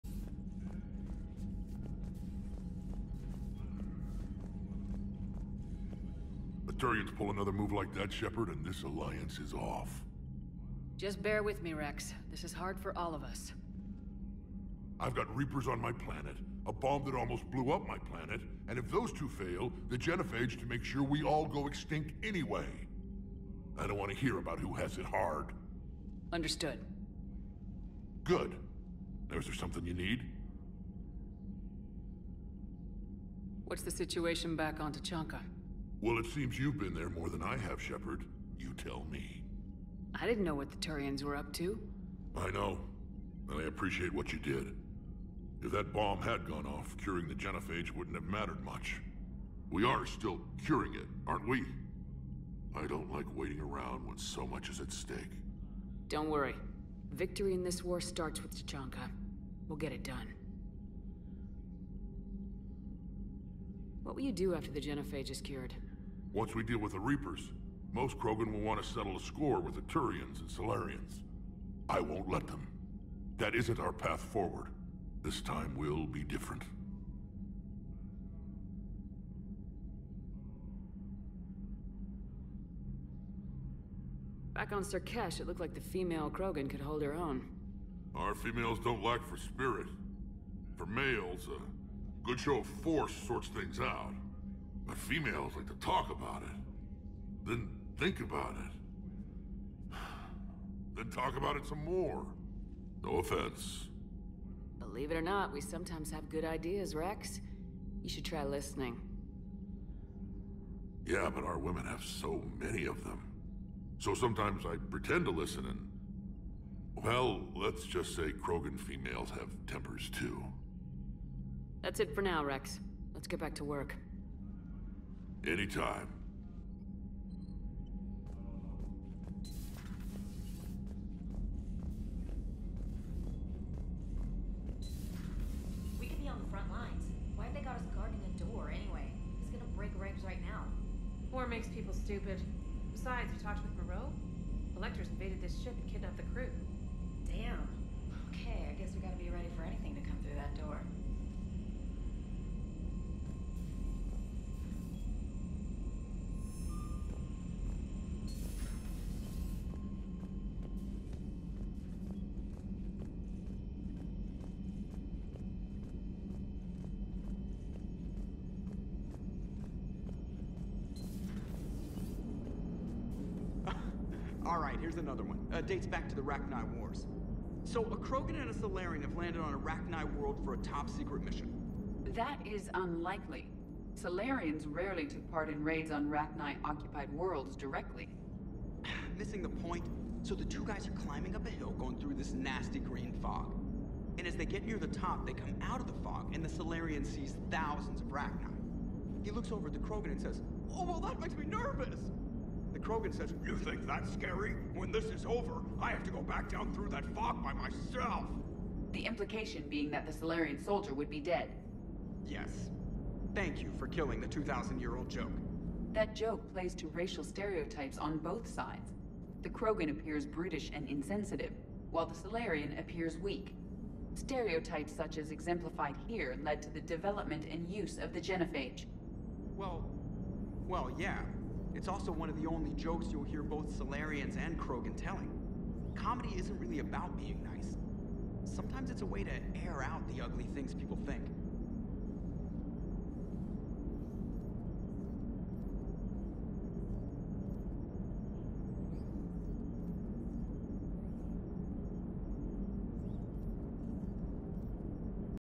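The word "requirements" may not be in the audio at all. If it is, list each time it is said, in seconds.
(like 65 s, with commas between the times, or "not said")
not said.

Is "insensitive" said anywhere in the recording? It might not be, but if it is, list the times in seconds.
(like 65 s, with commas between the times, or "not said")
220 s.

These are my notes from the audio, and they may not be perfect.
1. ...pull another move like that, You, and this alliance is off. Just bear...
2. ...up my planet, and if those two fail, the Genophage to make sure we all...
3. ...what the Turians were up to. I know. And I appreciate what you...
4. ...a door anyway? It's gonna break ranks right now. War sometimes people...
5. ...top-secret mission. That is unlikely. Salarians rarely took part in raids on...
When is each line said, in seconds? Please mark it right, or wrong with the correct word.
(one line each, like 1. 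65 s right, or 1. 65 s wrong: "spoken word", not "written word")
1. 7 s wrong: "Shepard", not "You"
2. 17 s right
3. 40 s right
4. 138 s wrong: "makes", not "sometimes"
5. 180 s right.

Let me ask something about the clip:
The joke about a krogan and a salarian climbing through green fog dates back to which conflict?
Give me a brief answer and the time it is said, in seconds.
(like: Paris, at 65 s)
Rachni Wars, at 176 s.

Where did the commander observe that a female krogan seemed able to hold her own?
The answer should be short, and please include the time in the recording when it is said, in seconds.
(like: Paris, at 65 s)
Sur'Kesh, at 84 s.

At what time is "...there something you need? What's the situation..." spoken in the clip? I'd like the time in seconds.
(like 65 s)
29 s.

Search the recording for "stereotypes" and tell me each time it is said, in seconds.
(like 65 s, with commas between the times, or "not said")
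217 s, 224 s.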